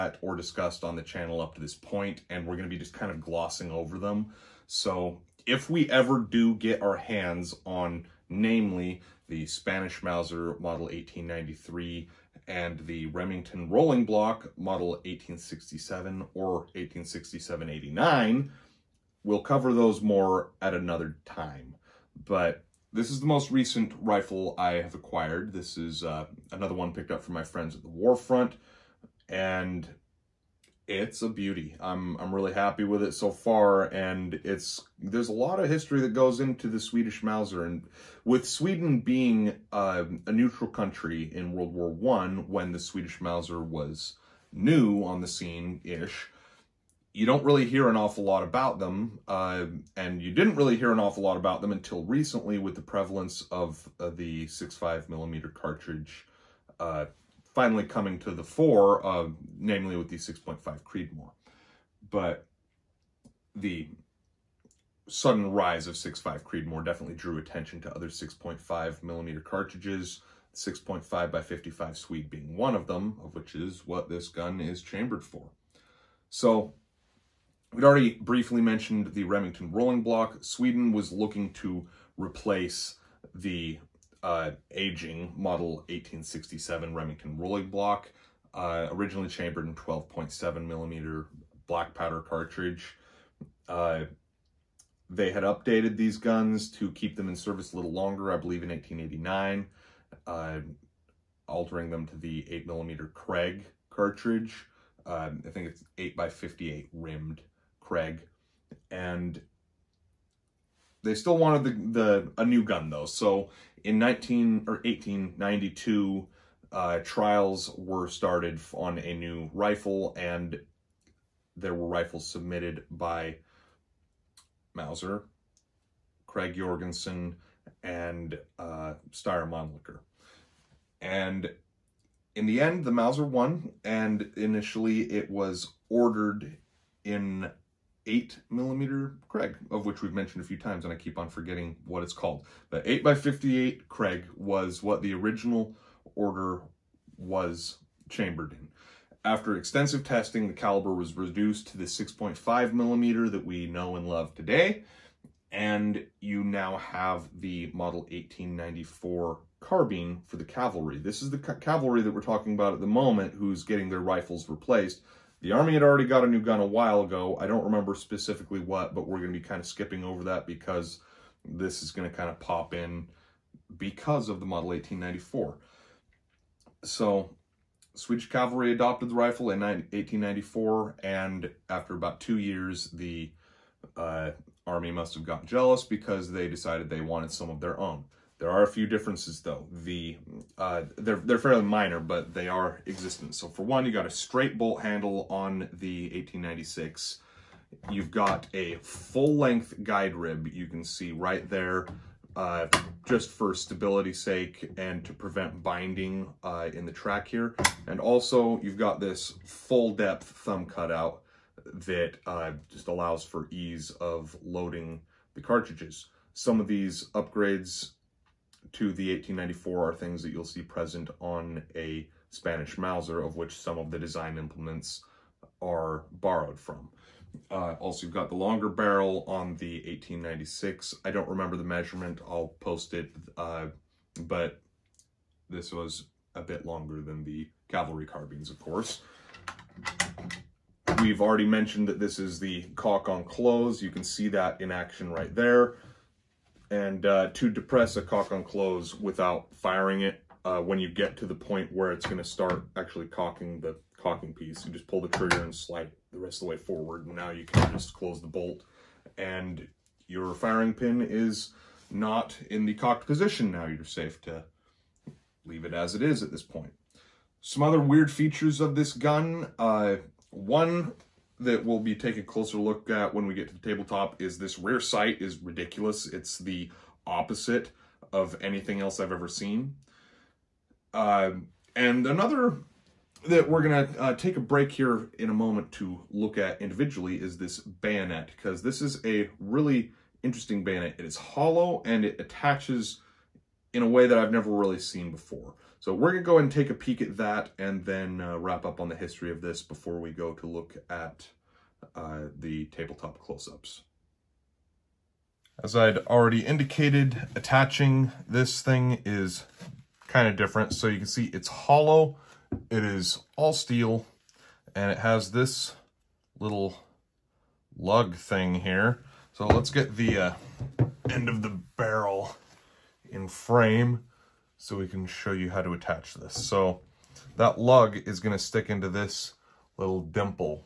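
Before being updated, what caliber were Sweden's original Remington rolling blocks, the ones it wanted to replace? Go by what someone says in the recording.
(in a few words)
12.7 millimeter.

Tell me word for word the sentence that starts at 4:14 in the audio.
You just pull the trigger and slide the rest of the way forward.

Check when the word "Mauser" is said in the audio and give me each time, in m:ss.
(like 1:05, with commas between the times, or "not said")
0:10, 0:37, 0:43, 2:04, 2:12, 3:42.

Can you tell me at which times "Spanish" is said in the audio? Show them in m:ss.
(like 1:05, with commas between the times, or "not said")
0:09, 3:42.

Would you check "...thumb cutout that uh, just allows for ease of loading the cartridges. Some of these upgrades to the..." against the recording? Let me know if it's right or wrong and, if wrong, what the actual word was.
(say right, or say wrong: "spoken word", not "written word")
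right.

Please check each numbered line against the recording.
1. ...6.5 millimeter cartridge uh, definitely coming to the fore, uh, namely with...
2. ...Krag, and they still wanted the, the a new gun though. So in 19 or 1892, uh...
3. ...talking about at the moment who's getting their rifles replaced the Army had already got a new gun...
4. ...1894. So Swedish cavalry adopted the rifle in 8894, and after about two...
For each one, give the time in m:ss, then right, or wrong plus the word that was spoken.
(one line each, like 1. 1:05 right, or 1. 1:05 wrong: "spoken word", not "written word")
1. 0:54 wrong: "finally", not "definitely"
2. 1:47 right
3. 2:42 right
4. 2:54 wrong: "1894", not "8894".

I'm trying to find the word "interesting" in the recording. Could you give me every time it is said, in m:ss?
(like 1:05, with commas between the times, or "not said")
4:50.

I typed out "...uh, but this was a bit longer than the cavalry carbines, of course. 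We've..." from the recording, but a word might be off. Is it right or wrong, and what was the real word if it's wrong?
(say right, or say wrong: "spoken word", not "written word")
right.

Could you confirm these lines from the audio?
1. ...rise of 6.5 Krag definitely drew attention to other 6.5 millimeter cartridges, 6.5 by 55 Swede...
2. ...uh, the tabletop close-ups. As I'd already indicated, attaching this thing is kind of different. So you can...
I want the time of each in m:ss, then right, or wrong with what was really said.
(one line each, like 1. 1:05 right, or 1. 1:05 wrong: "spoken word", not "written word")
1. 1:05 wrong: "Creedmoor", not "Krag"
2. 5:01 right.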